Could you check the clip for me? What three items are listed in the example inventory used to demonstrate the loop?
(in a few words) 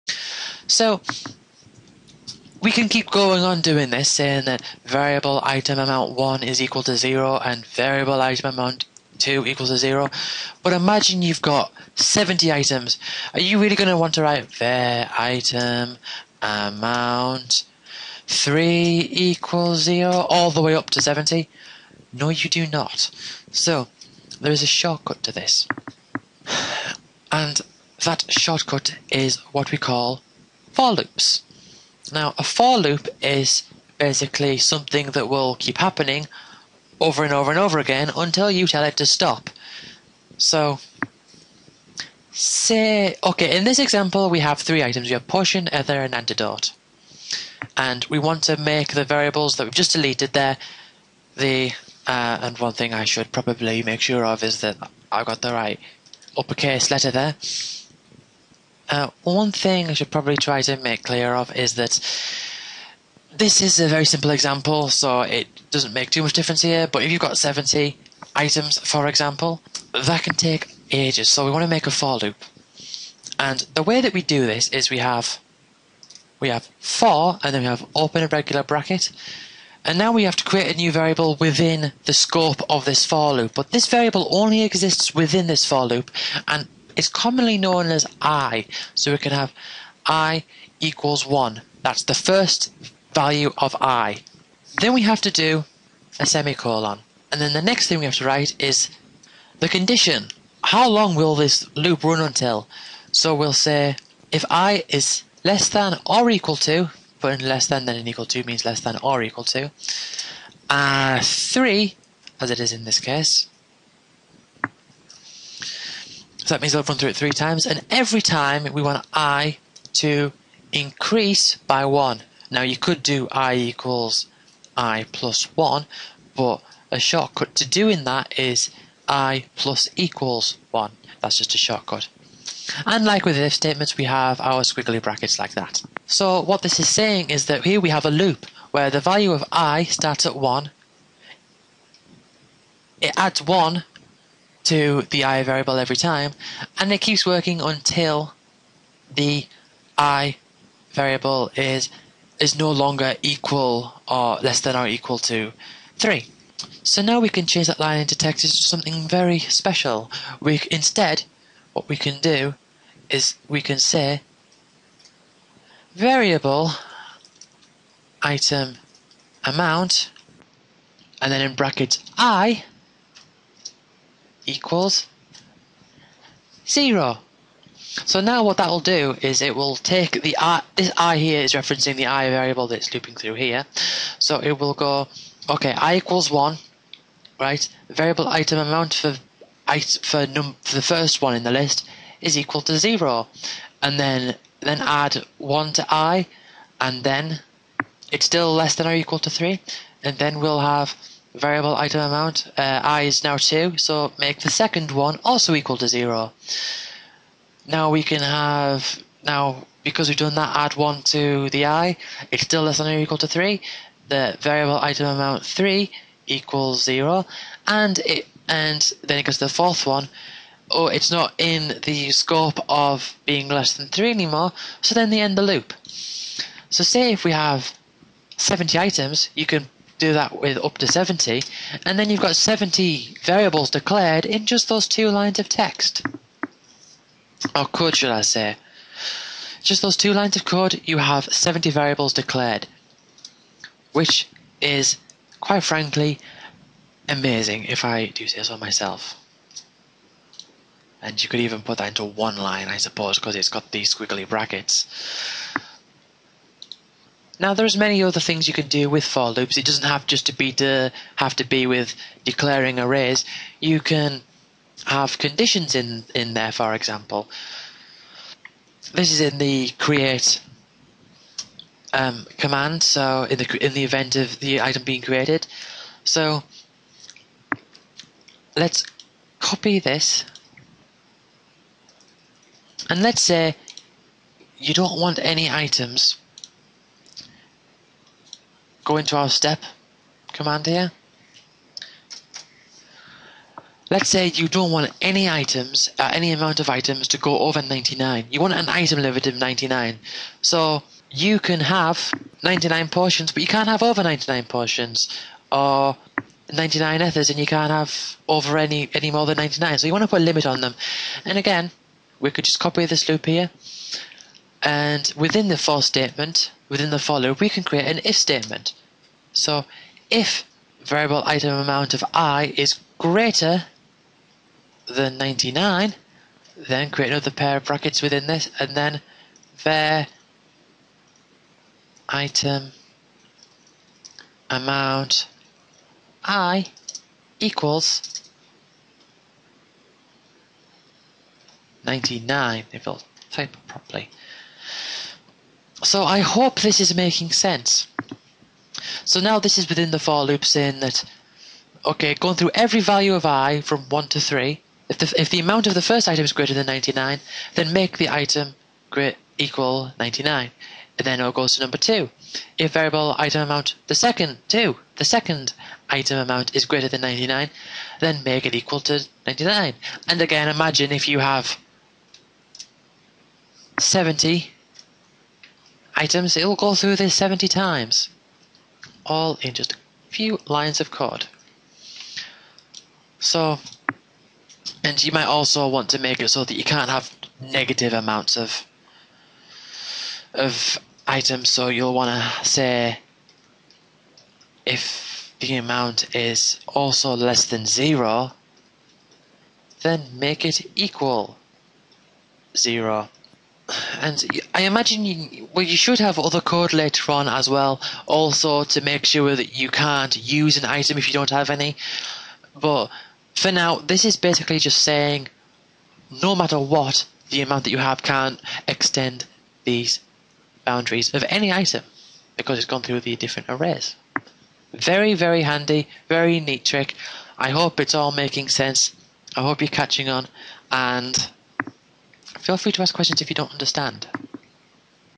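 potion, ether, and antidote.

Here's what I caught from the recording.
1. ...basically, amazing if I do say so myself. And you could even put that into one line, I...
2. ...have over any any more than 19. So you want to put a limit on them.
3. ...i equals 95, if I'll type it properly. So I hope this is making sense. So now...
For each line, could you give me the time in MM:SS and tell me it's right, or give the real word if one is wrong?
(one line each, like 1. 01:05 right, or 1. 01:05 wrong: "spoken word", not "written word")
1. 04:05 wrong: "frankly", not "basically"
2. 05:07 wrong: "99", not "19"
3. 05:36 wrong: "99", not "95".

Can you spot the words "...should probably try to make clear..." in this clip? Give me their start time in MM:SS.
00:59.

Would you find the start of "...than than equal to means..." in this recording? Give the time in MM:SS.
01:47.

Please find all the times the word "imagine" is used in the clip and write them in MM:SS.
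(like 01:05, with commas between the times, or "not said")
00:10, 06:10, 06:44.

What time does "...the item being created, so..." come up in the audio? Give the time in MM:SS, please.
04:34.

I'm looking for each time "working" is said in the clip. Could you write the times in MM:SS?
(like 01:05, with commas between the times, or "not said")
02:27.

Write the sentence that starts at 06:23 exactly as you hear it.
So, and you might also want to make it so that you can't have negative amounts of of items.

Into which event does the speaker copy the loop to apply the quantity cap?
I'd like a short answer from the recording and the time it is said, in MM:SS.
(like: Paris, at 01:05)
step, at 04:49.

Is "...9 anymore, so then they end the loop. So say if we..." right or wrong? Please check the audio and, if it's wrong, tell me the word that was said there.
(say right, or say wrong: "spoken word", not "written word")
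wrong: "3", not "9".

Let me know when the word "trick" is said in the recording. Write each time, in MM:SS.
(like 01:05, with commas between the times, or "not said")
07:06.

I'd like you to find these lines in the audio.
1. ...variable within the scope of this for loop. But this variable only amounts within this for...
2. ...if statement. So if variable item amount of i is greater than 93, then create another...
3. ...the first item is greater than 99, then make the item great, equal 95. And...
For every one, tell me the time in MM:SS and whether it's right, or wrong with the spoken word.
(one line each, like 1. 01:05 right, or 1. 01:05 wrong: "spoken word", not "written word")
1. 01:20 wrong: "exists", not "amounts"
2. 05:18 wrong: "99", not "93"
3. 05:55 wrong: "99", not "95".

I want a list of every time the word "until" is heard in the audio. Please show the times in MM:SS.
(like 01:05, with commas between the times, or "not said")
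00:38, 01:42, 02:27.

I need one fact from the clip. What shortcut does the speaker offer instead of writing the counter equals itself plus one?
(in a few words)
i += 1.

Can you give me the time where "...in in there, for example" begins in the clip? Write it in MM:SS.
04:25.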